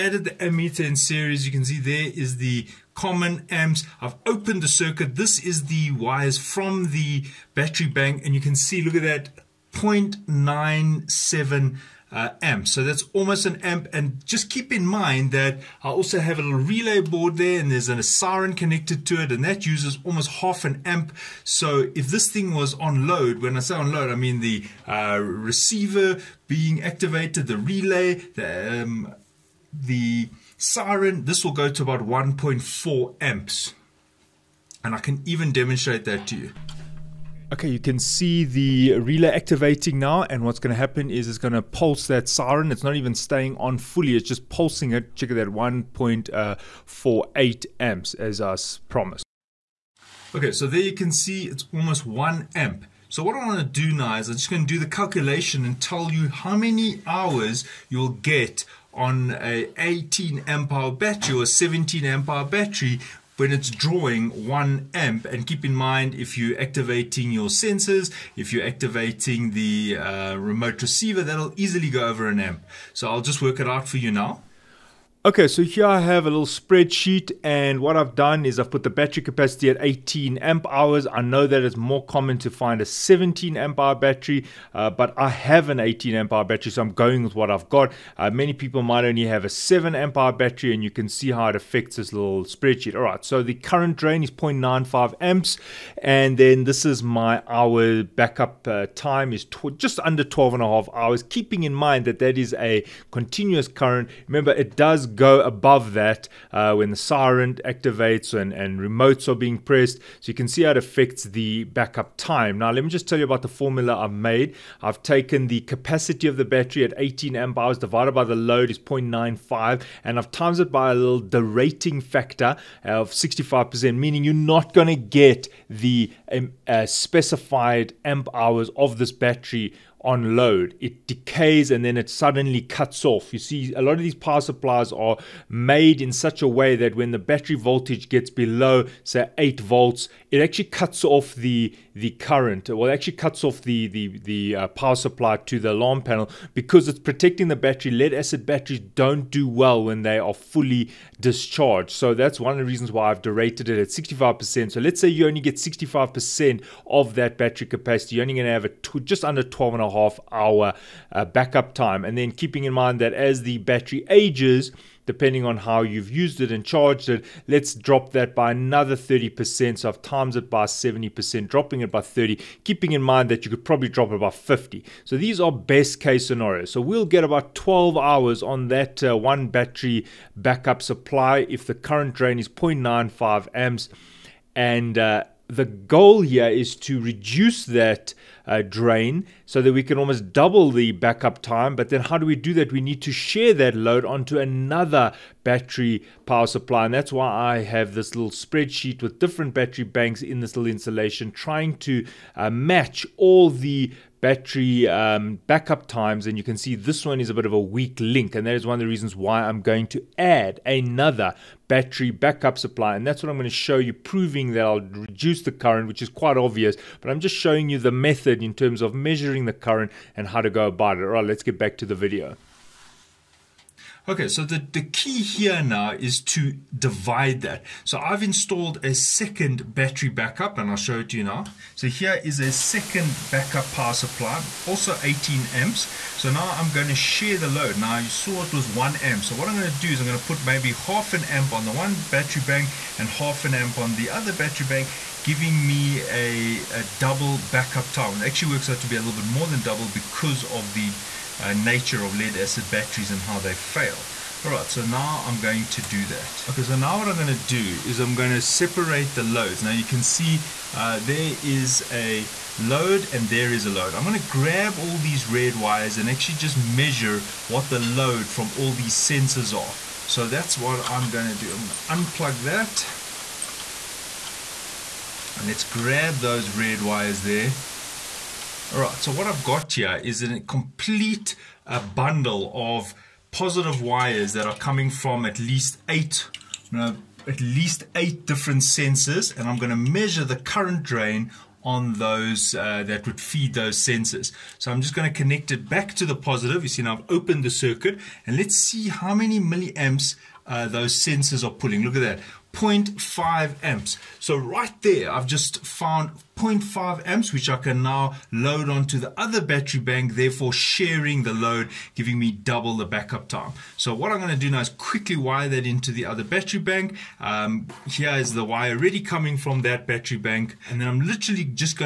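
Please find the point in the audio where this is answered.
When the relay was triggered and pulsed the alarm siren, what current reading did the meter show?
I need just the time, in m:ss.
0:45.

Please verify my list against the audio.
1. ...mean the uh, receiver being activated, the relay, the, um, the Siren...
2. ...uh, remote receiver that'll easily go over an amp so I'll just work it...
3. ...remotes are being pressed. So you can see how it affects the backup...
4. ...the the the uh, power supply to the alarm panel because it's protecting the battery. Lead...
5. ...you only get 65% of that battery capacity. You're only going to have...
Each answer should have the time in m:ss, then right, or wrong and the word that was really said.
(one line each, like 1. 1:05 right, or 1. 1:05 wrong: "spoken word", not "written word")
1. 0:24 right
2. 1:09 right
3. 1:48 right
4. 2:23 right
5. 2:35 right.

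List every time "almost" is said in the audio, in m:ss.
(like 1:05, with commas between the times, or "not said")
0:13, 0:20, 0:51, 3:09.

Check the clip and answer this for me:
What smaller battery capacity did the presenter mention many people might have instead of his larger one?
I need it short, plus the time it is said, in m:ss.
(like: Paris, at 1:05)
7 amp hours, at 1:29.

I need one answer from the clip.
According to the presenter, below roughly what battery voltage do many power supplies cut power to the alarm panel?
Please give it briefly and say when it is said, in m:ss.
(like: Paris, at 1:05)
8 volts, at 2:19.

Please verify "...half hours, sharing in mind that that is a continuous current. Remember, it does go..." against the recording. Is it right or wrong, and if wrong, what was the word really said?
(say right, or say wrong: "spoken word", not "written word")
wrong: "keeping", not "sharing".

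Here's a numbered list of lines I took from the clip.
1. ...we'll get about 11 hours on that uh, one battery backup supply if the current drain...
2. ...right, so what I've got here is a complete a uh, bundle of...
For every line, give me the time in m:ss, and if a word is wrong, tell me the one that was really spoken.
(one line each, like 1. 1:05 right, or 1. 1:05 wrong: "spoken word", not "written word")
1. 2:56 wrong: "12", not "11"
2. 4:38 right.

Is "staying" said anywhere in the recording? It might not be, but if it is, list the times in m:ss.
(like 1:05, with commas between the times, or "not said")
0:43.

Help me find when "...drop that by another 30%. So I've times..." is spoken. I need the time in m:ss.
2:47.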